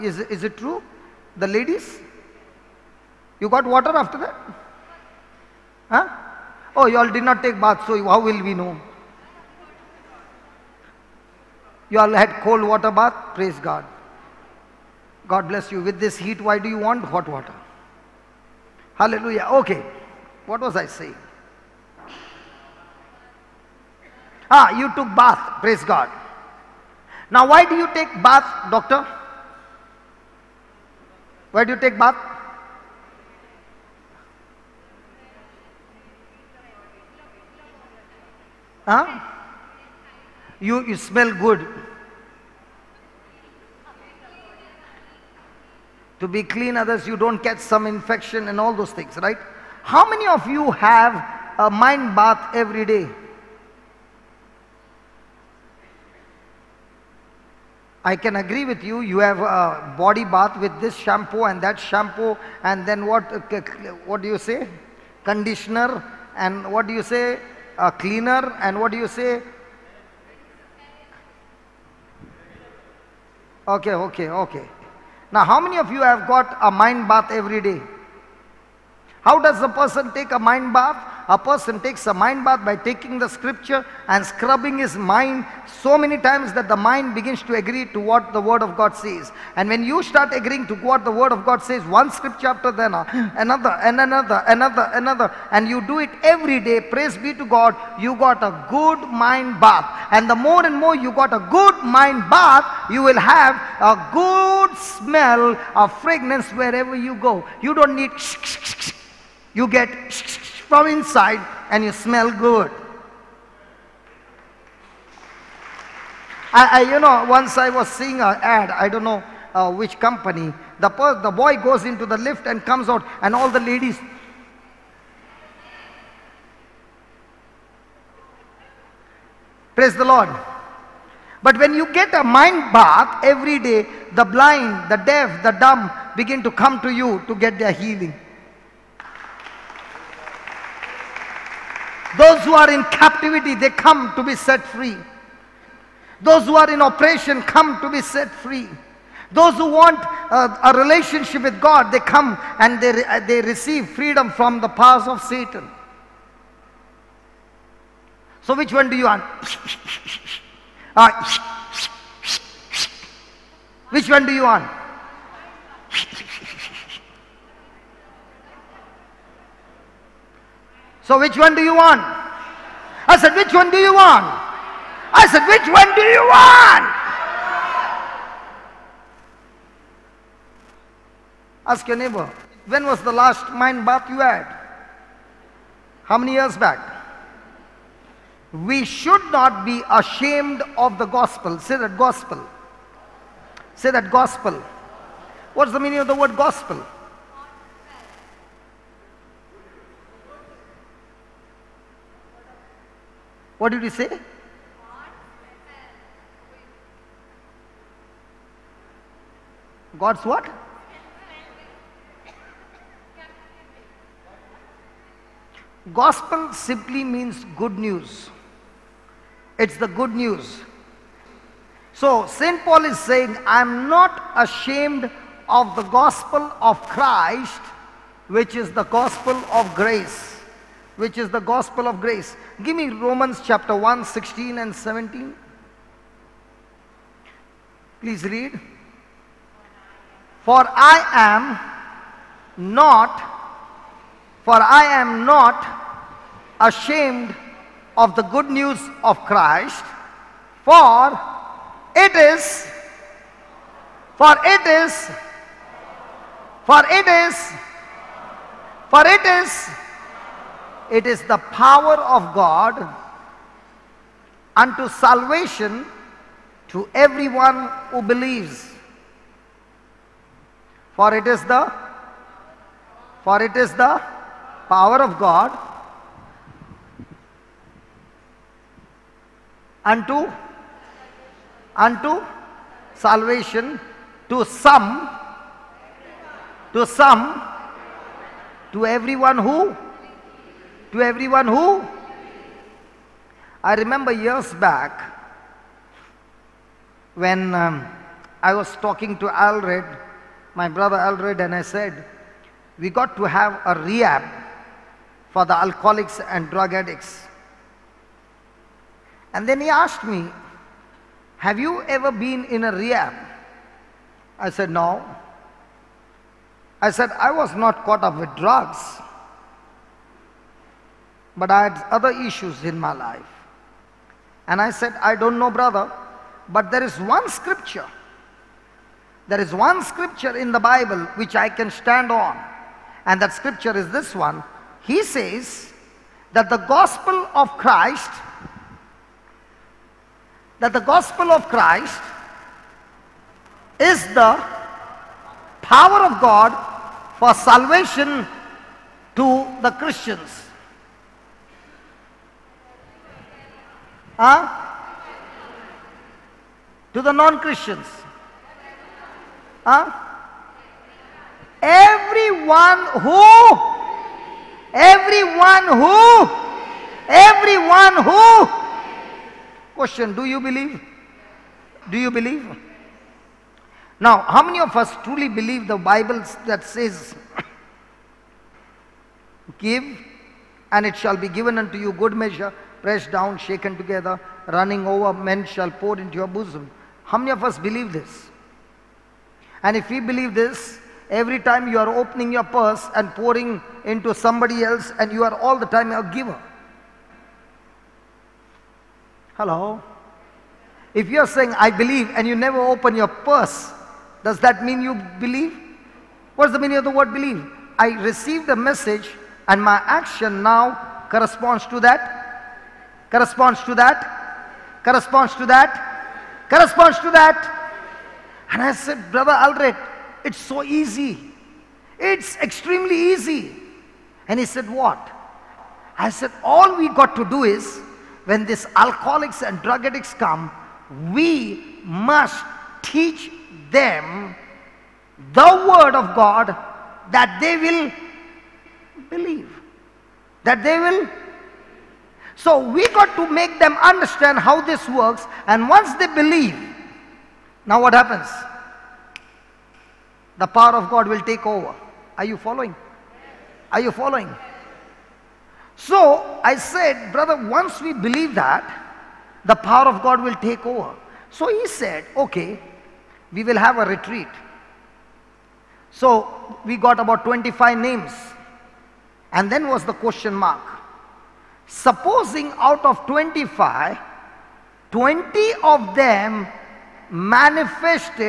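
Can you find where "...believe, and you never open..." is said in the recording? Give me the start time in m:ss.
6:41.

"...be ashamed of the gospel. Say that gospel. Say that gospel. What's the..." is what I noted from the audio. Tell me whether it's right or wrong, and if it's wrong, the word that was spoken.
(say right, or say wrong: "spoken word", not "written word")
right.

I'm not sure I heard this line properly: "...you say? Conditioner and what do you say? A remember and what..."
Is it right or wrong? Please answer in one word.
wrong.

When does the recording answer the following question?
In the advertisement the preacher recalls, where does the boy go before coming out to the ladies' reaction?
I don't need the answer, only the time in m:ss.
2:02.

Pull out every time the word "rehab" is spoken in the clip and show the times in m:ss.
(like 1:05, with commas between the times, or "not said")
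5:03, 5:12.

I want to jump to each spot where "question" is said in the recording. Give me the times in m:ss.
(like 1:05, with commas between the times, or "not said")
6:09, 7:49.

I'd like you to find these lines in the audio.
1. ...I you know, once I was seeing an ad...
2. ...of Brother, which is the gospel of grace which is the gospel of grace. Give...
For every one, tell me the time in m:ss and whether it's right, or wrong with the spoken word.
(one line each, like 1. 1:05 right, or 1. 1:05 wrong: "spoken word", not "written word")
1. 1:56 right
2. 3:46 wrong: "Christ", not "Brother".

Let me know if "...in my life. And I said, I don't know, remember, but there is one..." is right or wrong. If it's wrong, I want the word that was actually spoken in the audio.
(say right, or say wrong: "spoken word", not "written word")
wrong: "brother", not "remember".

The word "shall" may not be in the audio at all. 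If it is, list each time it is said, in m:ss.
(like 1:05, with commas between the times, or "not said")
6:20, 6:25.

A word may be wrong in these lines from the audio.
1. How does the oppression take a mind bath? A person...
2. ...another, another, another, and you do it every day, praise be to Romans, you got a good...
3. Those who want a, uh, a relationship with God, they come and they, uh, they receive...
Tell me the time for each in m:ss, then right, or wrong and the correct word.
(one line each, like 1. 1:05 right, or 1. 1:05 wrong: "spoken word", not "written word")
1. 1:19 wrong: "person", not "oppression"
2. 1:33 wrong: "God", not "Romans"
3. 2:29 right.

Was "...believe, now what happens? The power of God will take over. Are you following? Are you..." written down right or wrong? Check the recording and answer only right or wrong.
right.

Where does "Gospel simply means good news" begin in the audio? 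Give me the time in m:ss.
3:35.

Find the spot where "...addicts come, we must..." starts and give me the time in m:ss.
7:09.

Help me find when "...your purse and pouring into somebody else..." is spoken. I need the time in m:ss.
6:32.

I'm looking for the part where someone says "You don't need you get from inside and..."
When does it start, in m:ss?
1:47.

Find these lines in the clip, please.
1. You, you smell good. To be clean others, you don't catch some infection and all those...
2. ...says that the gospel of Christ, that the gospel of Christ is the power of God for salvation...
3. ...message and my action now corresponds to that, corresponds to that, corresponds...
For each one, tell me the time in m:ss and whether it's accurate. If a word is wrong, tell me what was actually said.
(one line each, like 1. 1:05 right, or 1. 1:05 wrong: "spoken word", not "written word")
1. 0:40 right
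2. 5:35 right
3. 6:48 right.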